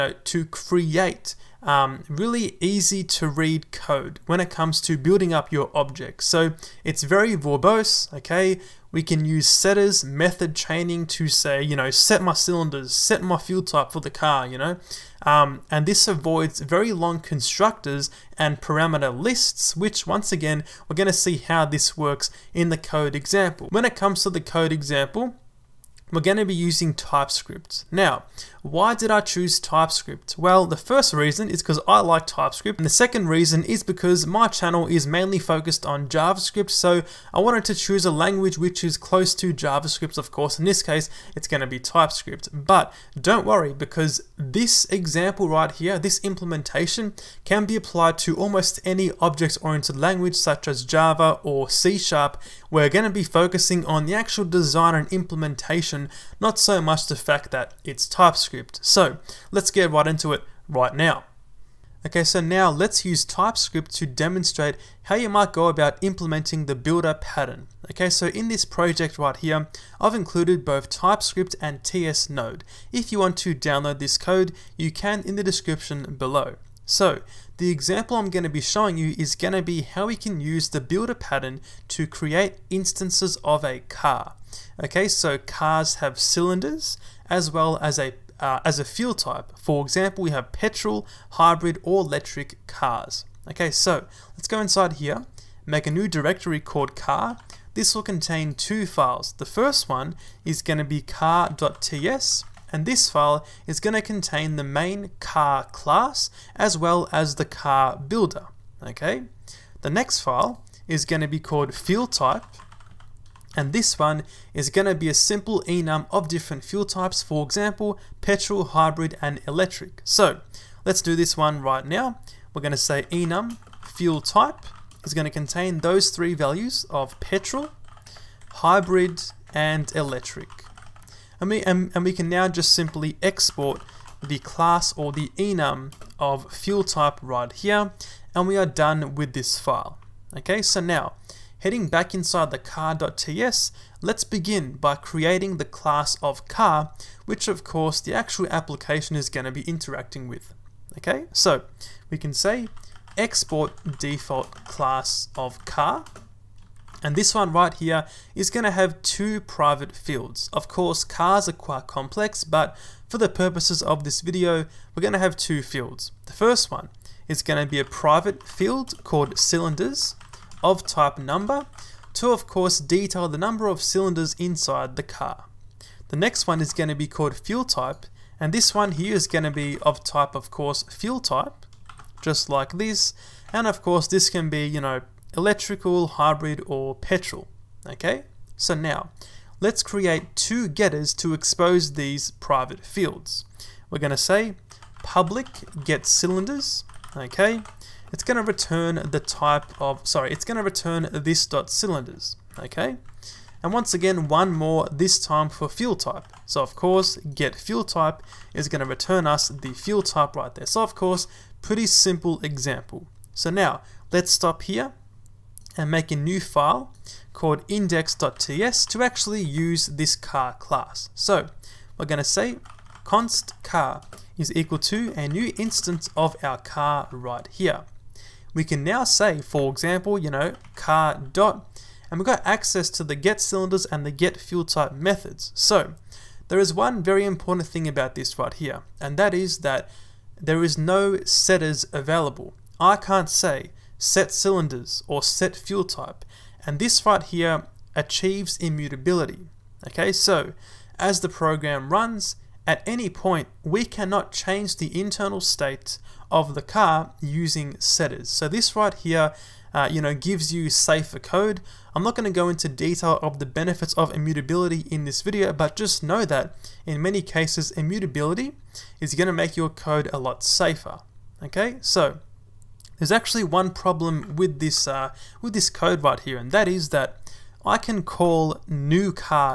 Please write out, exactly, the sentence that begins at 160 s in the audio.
Of course, cars are quite complex, but for the purposes of this video, we're going to have two fields.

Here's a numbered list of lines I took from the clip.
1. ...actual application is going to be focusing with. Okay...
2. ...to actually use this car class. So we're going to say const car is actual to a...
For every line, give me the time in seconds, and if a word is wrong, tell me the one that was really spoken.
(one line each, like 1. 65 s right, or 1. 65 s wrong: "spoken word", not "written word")
1. 148 s wrong: "interacting", not "focusing"
2. 218 s wrong: "equal", not "actual".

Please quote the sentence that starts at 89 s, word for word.
For example, we have petrol, hybrid, or electric cars.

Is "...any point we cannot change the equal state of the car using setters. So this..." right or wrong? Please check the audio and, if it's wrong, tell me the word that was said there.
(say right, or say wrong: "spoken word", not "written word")
wrong: "internal", not "equal".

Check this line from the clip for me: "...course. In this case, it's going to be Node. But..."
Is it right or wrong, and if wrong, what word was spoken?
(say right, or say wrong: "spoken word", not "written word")
wrong: "TypeScript", not "Node".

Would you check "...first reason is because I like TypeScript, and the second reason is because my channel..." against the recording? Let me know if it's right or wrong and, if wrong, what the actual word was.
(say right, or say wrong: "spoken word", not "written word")
right.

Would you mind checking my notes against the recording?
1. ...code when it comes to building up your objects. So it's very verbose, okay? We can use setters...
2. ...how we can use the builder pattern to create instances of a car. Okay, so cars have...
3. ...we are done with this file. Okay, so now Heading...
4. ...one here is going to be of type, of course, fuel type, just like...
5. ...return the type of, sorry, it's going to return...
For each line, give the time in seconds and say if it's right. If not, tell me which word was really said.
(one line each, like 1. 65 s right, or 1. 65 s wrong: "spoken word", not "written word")
1. 3 s right
2. 79 s right
3. 138 s right
4. 178 s right
5. 198 s right.